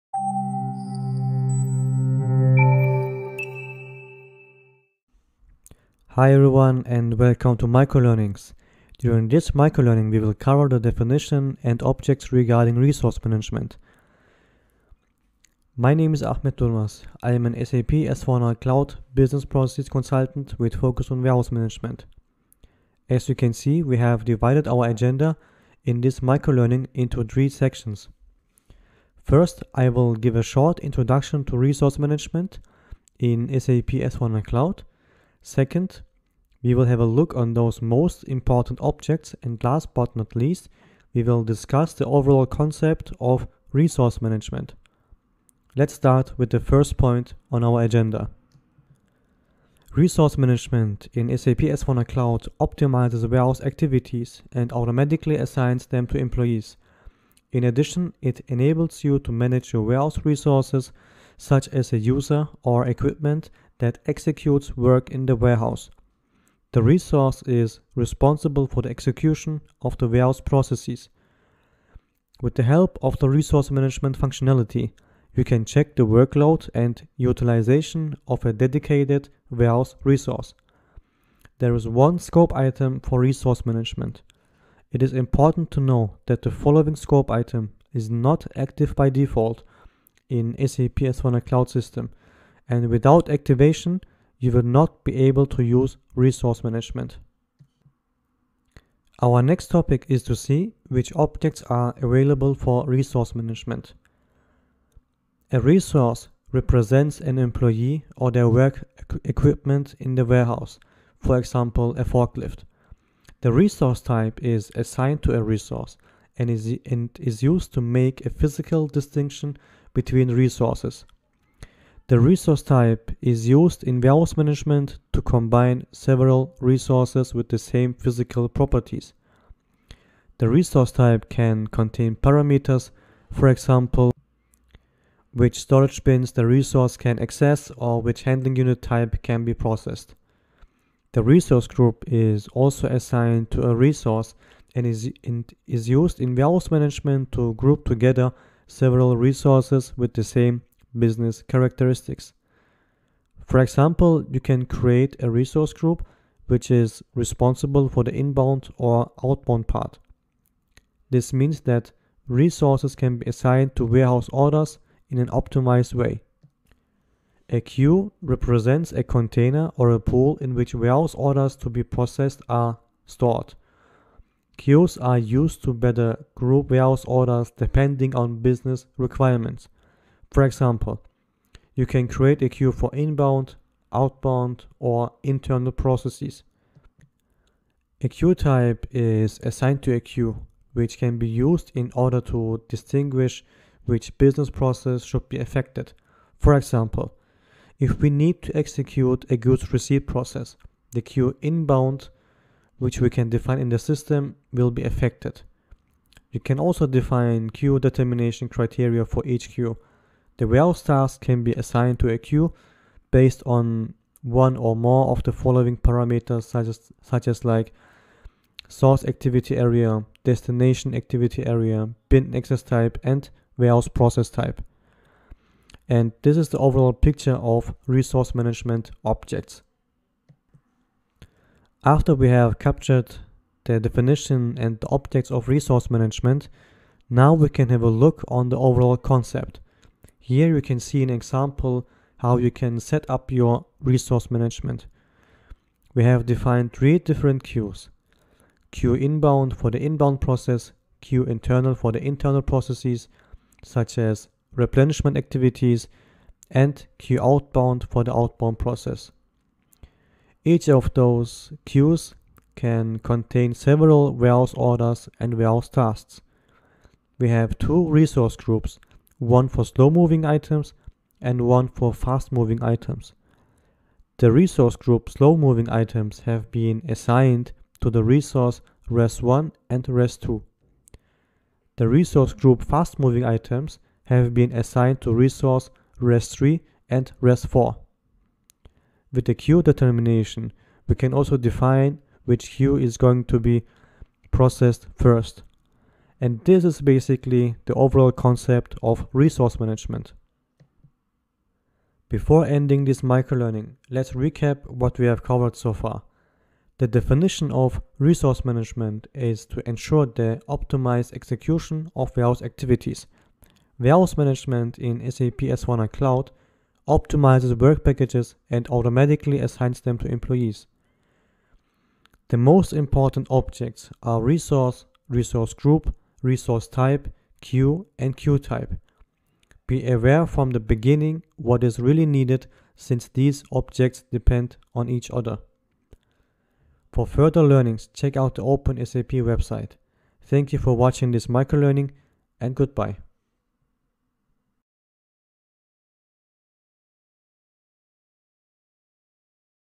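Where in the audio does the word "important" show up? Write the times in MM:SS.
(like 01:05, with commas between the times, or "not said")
00:38, 01:25, 05:22.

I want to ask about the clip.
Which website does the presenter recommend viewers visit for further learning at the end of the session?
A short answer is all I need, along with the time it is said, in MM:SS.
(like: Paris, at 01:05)
OpenSAP, at 05:38.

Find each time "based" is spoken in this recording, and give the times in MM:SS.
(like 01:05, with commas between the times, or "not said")
03:33.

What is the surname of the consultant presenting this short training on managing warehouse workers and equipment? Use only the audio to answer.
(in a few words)
Durmas.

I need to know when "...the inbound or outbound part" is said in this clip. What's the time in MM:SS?
02:38.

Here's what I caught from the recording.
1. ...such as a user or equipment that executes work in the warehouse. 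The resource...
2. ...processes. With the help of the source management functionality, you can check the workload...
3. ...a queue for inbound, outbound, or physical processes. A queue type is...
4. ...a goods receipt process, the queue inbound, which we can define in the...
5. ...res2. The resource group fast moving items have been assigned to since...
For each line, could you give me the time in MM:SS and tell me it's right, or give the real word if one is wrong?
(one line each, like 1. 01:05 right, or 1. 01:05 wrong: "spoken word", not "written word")
1. 01:01 right
2. 01:10 wrong: "resource", not "source"
3. 03:02 wrong: "internal", not "physical"
4. 03:19 right
5. 04:39 wrong: "resource", not "since".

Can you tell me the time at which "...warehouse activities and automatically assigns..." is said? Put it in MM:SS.
00:53.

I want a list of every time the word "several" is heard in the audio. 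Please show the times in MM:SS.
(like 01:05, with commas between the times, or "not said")
02:05, 02:28, 04:23.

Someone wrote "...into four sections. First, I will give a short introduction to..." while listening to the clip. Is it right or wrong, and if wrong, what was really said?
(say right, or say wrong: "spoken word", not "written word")
wrong: "three", not "four".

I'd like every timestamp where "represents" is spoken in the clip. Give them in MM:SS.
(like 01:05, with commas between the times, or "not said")
01:46, 02:48.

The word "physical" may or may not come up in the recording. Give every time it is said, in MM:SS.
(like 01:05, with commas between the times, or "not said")
01:58, 02:07.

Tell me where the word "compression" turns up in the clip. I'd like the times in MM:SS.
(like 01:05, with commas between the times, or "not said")
not said.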